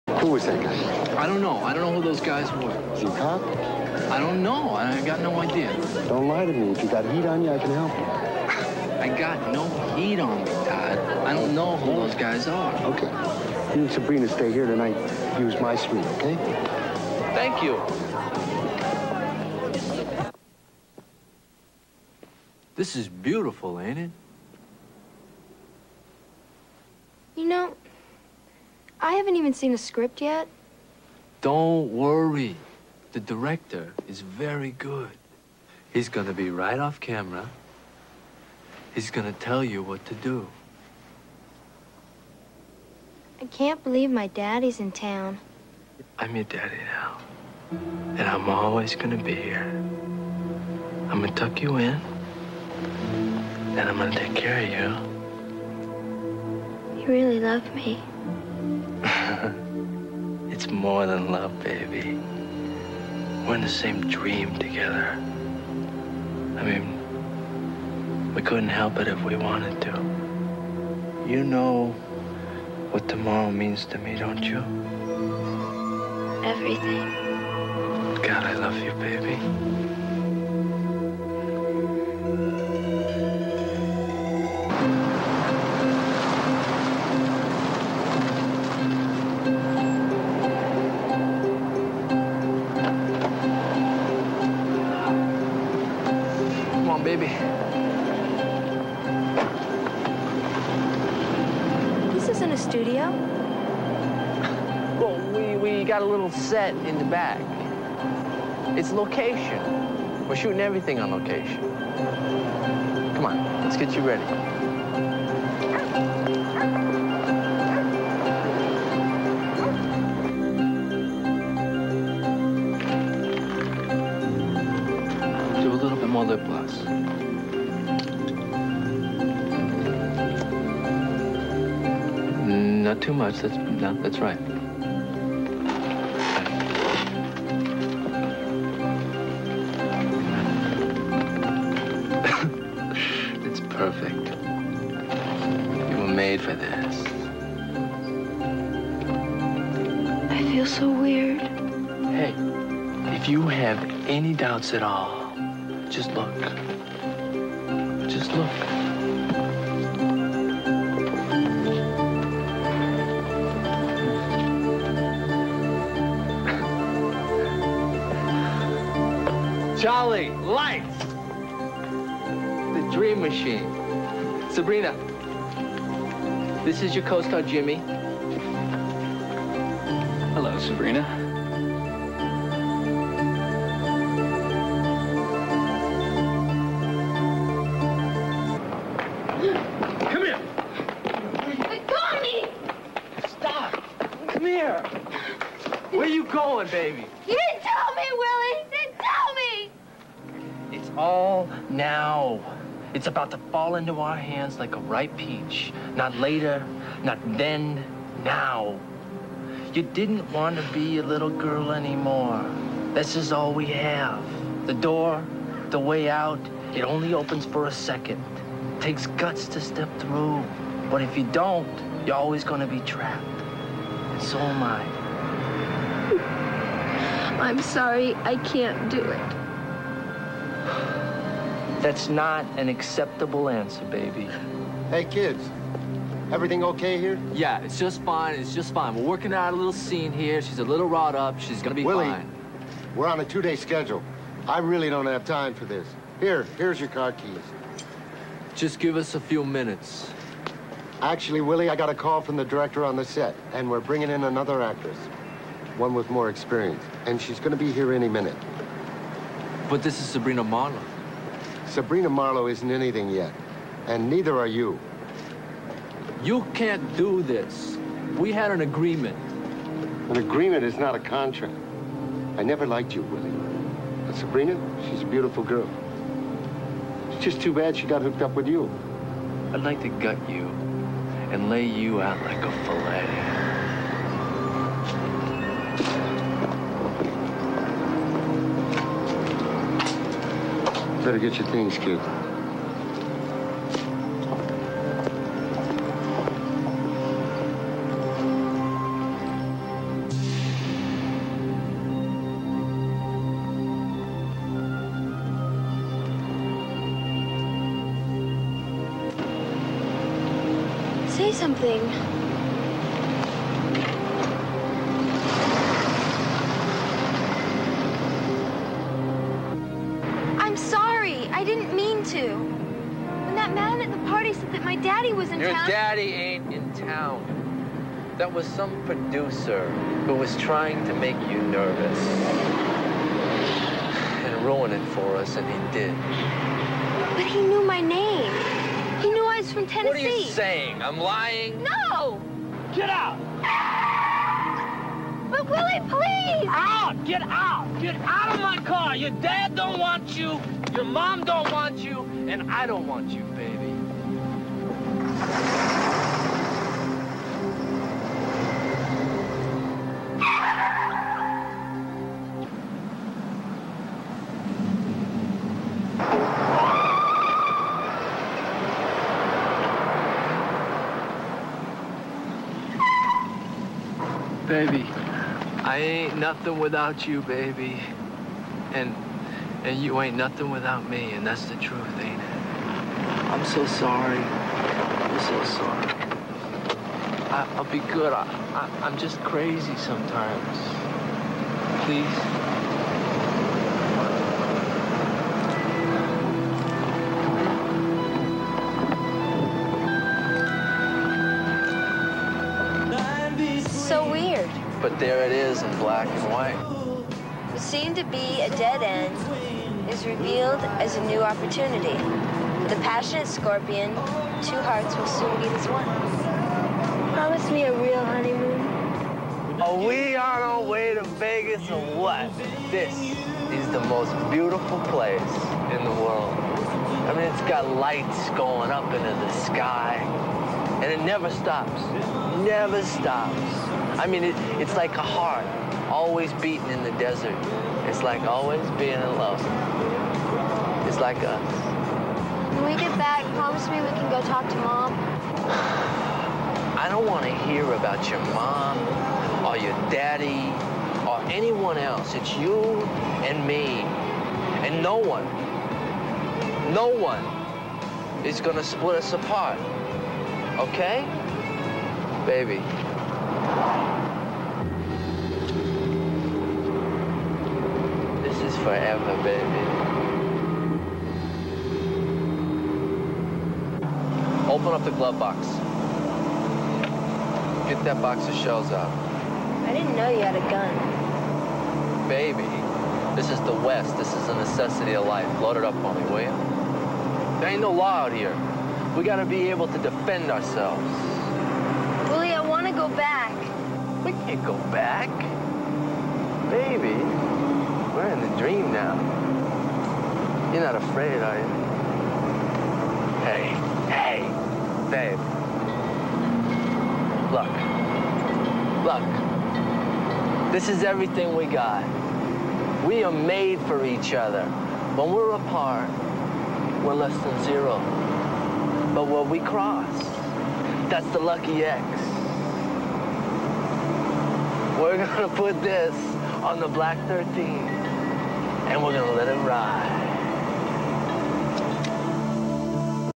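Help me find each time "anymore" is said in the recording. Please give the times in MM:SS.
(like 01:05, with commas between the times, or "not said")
03:31.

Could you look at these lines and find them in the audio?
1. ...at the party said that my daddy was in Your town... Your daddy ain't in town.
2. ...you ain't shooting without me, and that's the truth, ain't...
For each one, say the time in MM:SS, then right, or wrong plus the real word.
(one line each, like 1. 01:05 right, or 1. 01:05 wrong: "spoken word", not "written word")
1. 05:23 right
2. 06:19 wrong: "nothing", not "shooting".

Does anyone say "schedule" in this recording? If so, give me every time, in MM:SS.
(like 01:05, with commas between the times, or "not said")
04:03.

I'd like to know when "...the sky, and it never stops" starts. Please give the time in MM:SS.
07:09.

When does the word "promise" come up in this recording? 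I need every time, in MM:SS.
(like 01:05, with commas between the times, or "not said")
06:57, 07:23.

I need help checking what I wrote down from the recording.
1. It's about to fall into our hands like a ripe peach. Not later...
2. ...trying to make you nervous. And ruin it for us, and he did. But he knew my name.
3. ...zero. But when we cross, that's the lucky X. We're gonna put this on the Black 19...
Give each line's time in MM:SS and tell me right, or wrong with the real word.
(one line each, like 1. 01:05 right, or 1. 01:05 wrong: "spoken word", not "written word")
1. 03:22 right
2. 05:30 right
3. 08:37 wrong: "13", not "19".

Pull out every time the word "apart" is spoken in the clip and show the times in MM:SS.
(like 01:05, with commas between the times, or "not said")
07:39, 08:35.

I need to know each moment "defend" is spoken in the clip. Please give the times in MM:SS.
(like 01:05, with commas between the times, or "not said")
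08:09.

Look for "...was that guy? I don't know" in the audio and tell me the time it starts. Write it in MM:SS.
00:00.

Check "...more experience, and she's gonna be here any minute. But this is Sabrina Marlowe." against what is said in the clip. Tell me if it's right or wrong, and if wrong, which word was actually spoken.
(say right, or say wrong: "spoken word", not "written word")
right.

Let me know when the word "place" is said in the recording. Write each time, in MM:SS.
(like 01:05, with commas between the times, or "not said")
07:04.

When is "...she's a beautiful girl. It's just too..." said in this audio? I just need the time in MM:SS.
04:34.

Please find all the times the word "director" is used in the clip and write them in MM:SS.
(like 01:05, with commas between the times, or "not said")
00:33, 04:12.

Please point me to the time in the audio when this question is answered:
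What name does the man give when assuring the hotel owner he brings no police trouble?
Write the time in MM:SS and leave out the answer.
00:10.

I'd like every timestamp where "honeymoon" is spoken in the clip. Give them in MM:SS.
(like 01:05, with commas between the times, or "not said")
06:58.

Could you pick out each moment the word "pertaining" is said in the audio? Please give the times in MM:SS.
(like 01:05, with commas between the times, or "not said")
not said.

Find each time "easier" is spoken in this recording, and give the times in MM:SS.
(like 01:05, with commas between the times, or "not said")
not said.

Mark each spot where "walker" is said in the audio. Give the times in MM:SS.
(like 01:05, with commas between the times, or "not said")
not said.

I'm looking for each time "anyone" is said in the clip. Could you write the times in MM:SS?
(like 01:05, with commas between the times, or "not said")
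07:31.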